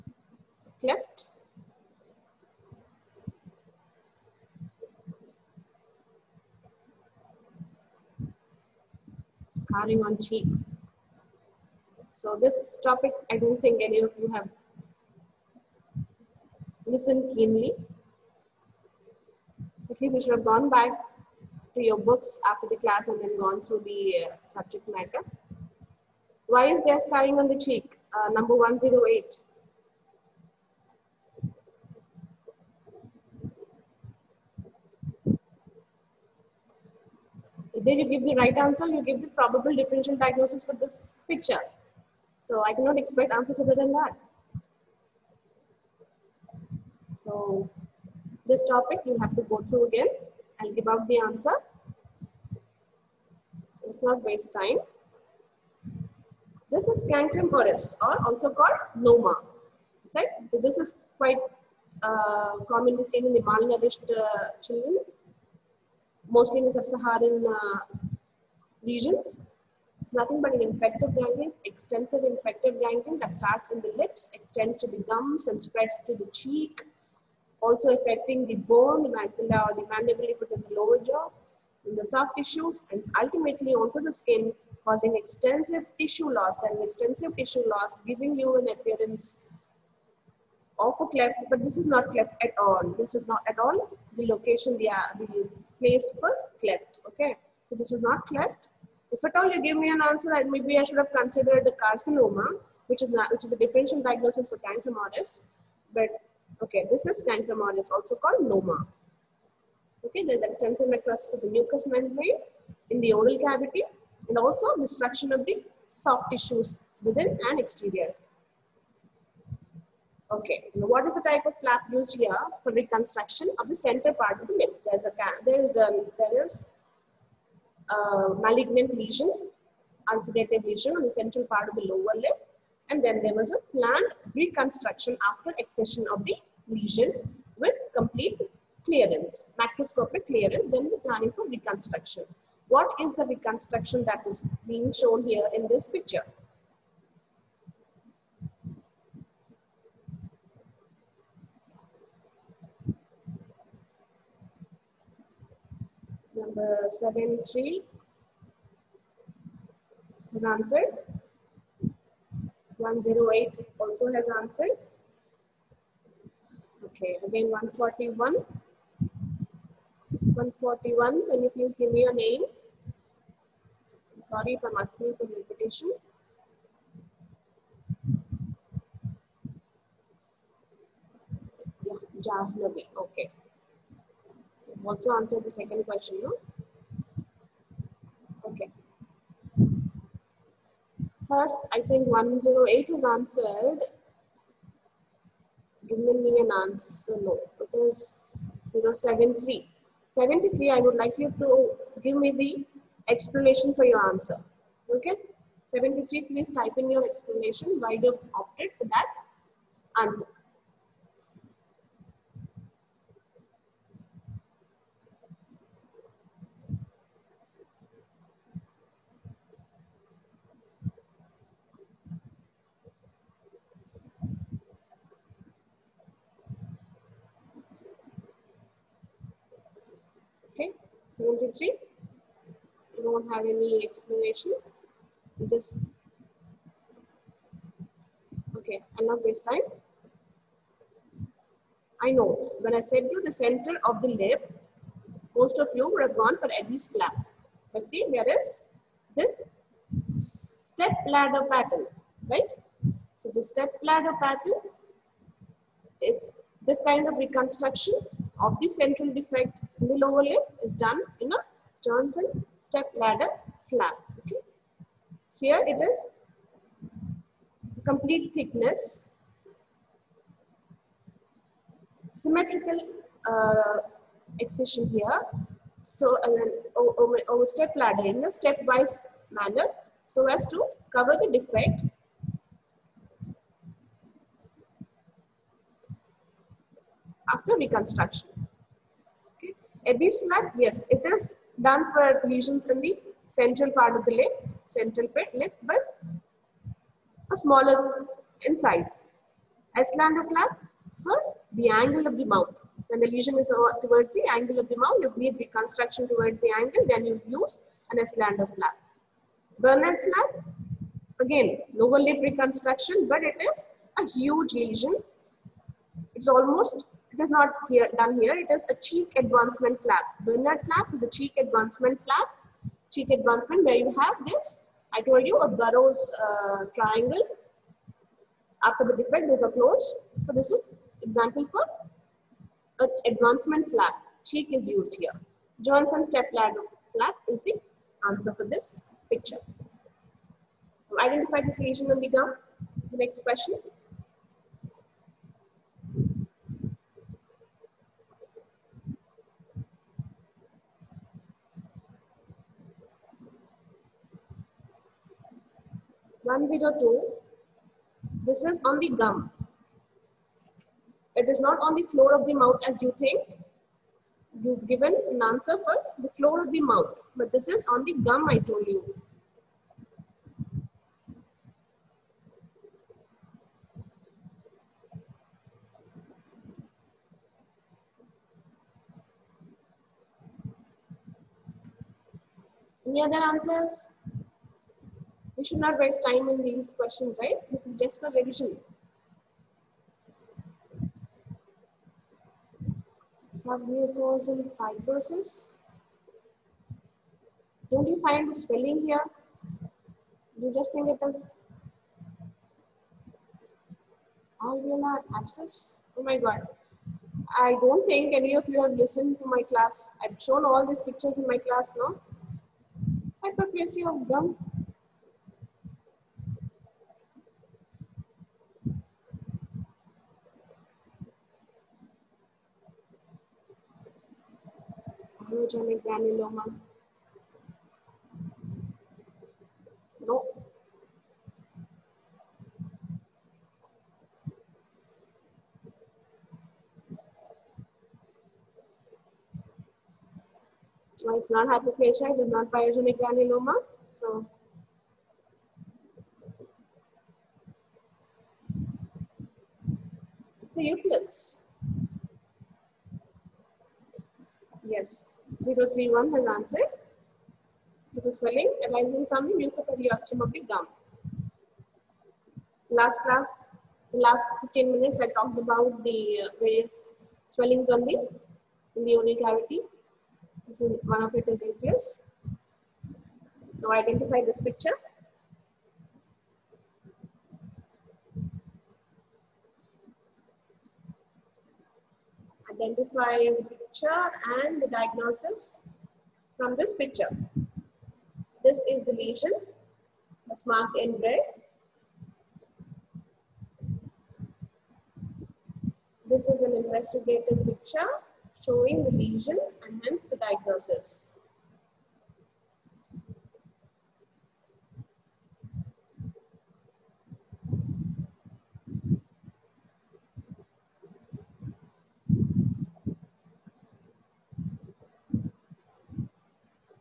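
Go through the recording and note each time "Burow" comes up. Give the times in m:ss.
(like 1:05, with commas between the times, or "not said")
5:25.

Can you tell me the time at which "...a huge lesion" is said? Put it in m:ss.
5:13.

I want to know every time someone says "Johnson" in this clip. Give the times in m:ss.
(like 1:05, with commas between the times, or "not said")
4:21, 5:35.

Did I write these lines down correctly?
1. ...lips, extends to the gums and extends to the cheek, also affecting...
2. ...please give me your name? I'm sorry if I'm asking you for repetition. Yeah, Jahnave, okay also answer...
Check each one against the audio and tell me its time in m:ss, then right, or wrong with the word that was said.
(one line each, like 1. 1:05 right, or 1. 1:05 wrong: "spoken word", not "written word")
1. 1:13 wrong: "spreads", not "extends"
2. 2:51 right.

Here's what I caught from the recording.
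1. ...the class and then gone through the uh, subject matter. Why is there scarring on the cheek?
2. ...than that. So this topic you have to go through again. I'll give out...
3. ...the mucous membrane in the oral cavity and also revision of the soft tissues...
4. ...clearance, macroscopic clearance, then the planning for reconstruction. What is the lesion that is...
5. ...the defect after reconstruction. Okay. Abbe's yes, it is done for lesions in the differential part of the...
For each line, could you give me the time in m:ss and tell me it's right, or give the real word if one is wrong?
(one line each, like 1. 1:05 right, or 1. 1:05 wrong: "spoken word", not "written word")
1. 0:22 right
2. 0:43 right
3. 1:51 wrong: "destruction", not "revision"
4. 2:18 wrong: "reconstruction", not "lesion"
5. 4:41 wrong: "central", not "differential".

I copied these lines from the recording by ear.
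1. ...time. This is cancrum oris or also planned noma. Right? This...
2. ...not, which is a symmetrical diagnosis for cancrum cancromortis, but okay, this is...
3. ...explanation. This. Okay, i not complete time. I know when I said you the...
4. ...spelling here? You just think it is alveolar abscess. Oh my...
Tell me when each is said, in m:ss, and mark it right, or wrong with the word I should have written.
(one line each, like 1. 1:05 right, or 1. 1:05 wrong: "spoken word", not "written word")
1. 0:54 wrong: "called", not "planned"
2. 1:43 wrong: "differential", not "symmetrical"
3. 3:53 wrong: "waste", not "complete"
4. 6:38 right.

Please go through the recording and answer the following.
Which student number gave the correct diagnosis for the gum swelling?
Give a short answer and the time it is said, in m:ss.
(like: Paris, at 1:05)
031, at 7:35.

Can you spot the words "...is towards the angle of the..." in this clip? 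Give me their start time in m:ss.
5:03.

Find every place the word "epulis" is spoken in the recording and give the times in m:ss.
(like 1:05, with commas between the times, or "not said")
7:30, 7:51.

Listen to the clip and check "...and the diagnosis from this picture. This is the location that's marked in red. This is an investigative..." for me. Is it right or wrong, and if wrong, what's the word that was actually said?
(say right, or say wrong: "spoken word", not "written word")
wrong: "lesion", not "location".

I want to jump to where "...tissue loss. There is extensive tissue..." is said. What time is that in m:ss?
1:25.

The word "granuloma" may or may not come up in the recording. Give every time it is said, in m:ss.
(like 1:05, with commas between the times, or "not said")
7:05, 7:22.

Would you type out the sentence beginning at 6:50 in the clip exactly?
I've shown all these pictures in my class, no?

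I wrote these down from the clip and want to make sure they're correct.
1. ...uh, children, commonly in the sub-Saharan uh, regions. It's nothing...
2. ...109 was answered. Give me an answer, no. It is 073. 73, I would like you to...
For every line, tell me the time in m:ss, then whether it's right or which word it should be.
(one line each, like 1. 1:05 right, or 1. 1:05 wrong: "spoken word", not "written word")
1. 1:04 wrong: "mostly", not "commonly"
2. 3:12 wrong: "108", not "109".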